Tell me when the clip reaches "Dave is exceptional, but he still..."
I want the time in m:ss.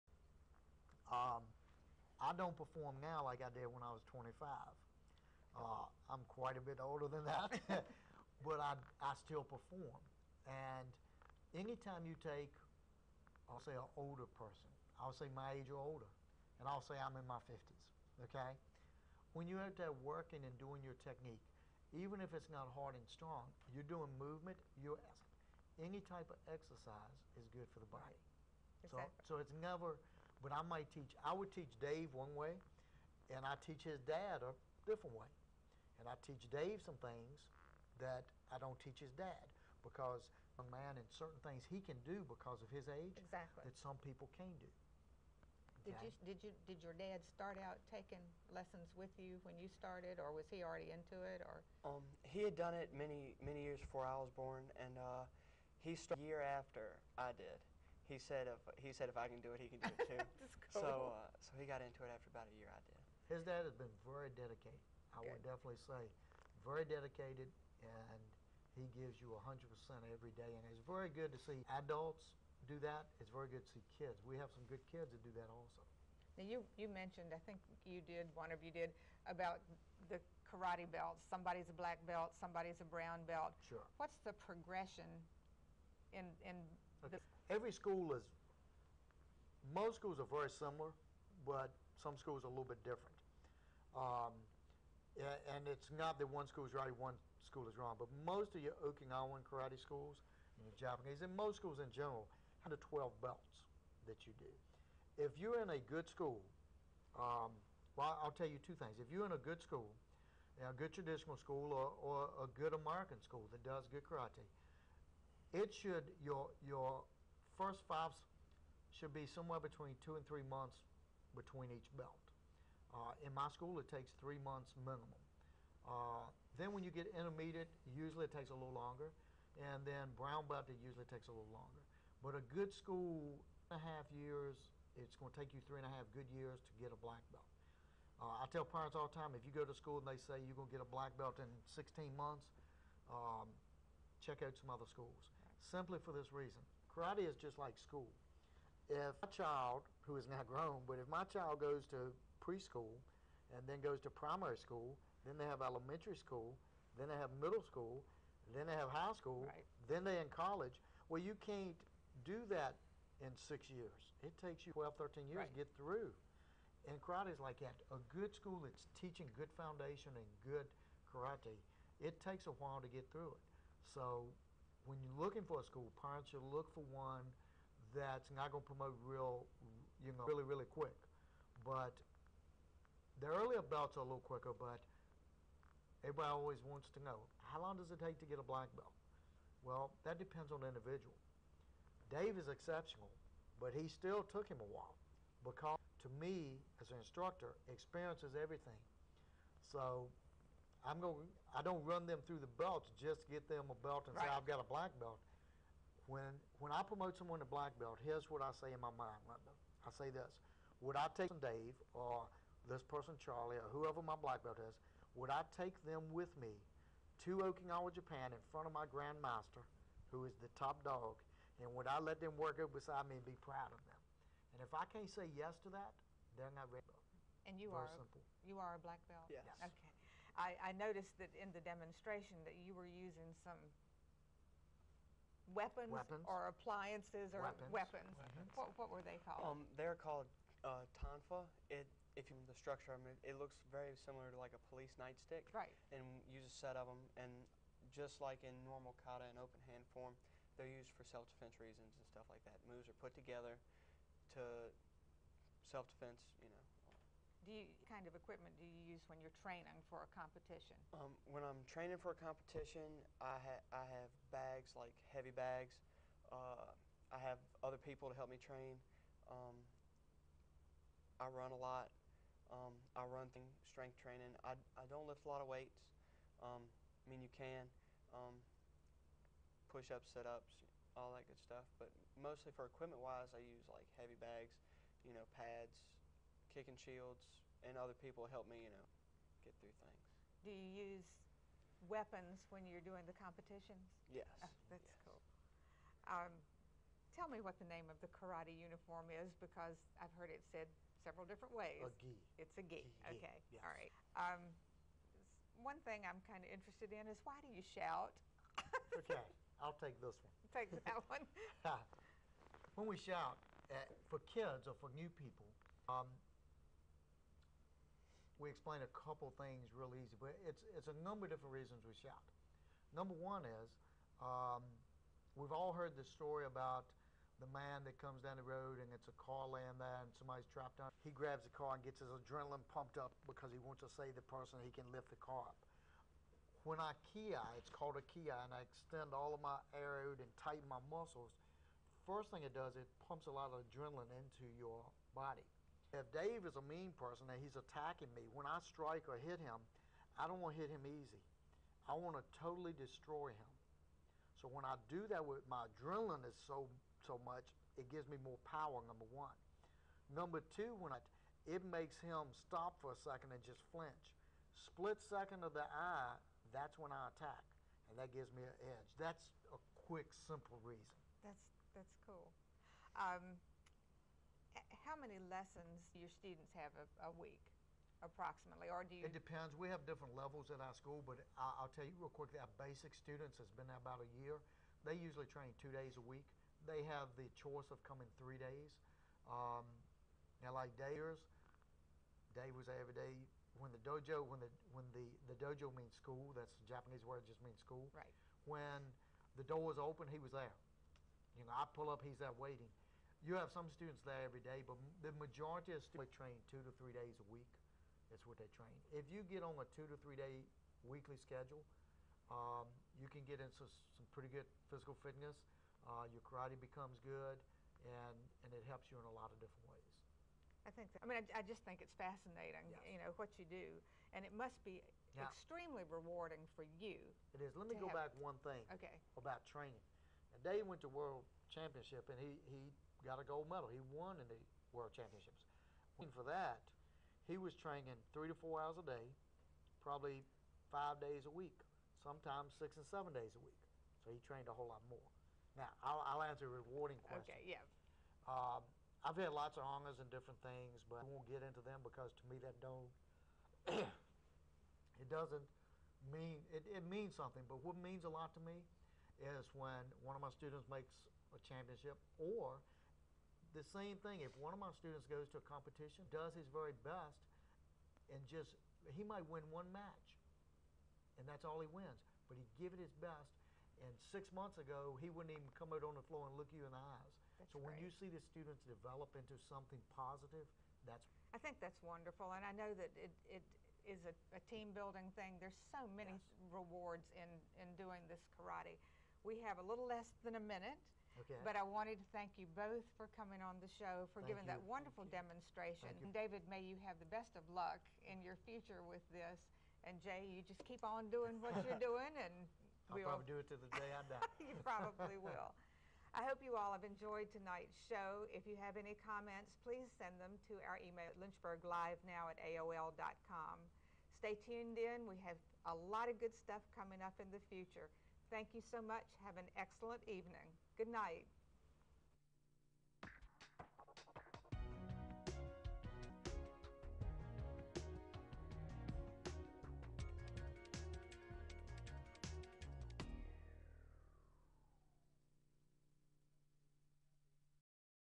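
3:12.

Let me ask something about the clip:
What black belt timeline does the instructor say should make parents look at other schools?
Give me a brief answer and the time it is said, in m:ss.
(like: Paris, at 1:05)
16 months, at 2:21.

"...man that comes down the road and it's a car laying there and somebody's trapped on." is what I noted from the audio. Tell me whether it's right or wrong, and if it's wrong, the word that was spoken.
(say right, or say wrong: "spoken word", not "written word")
right.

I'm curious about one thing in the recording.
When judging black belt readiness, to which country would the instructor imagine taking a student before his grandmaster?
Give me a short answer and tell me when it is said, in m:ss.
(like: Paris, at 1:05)
Japan, at 3:37.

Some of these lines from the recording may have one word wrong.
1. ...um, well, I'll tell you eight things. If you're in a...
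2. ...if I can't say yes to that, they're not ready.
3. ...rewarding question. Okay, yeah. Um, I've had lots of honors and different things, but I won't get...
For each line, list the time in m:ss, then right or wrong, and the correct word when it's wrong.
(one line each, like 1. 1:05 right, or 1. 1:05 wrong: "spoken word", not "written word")
1. 1:47 wrong: "two", not "eight"
2. 3:44 right
3. 7:26 right.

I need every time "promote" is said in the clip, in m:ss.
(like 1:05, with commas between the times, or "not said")
2:58, 3:26.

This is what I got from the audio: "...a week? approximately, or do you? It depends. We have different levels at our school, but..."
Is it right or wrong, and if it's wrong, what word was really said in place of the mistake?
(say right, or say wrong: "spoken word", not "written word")
right.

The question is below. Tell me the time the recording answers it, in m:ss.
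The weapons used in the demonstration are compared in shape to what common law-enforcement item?
4:04.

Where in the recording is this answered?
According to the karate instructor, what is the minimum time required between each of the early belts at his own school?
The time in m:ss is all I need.
2:04.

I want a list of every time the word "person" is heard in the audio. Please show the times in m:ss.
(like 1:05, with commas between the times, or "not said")
0:14, 3:32, 5:34, 5:46.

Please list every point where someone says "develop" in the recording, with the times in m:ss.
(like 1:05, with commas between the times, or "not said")
7:58.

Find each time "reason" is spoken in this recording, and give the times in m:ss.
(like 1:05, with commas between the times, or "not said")
2:26, 4:11, 5:21, 6:10.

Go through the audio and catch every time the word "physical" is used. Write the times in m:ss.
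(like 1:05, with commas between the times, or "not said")
6:54.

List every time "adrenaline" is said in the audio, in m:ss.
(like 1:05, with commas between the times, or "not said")
5:32, 5:43, 5:55.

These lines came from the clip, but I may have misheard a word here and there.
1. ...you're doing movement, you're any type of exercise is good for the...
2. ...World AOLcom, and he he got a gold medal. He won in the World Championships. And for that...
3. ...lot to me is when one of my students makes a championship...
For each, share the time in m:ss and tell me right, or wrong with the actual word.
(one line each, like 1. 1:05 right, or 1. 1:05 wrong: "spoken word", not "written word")
1. 0:23 right
2. 7:10 wrong: "Championship", not "AOLcom"
3. 7:38 right.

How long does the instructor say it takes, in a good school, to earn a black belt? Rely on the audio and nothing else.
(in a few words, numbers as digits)
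3 and a half years.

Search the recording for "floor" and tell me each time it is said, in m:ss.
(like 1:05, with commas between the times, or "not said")
7:56.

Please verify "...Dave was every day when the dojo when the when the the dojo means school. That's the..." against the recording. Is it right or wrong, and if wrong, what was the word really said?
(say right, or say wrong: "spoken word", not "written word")
right.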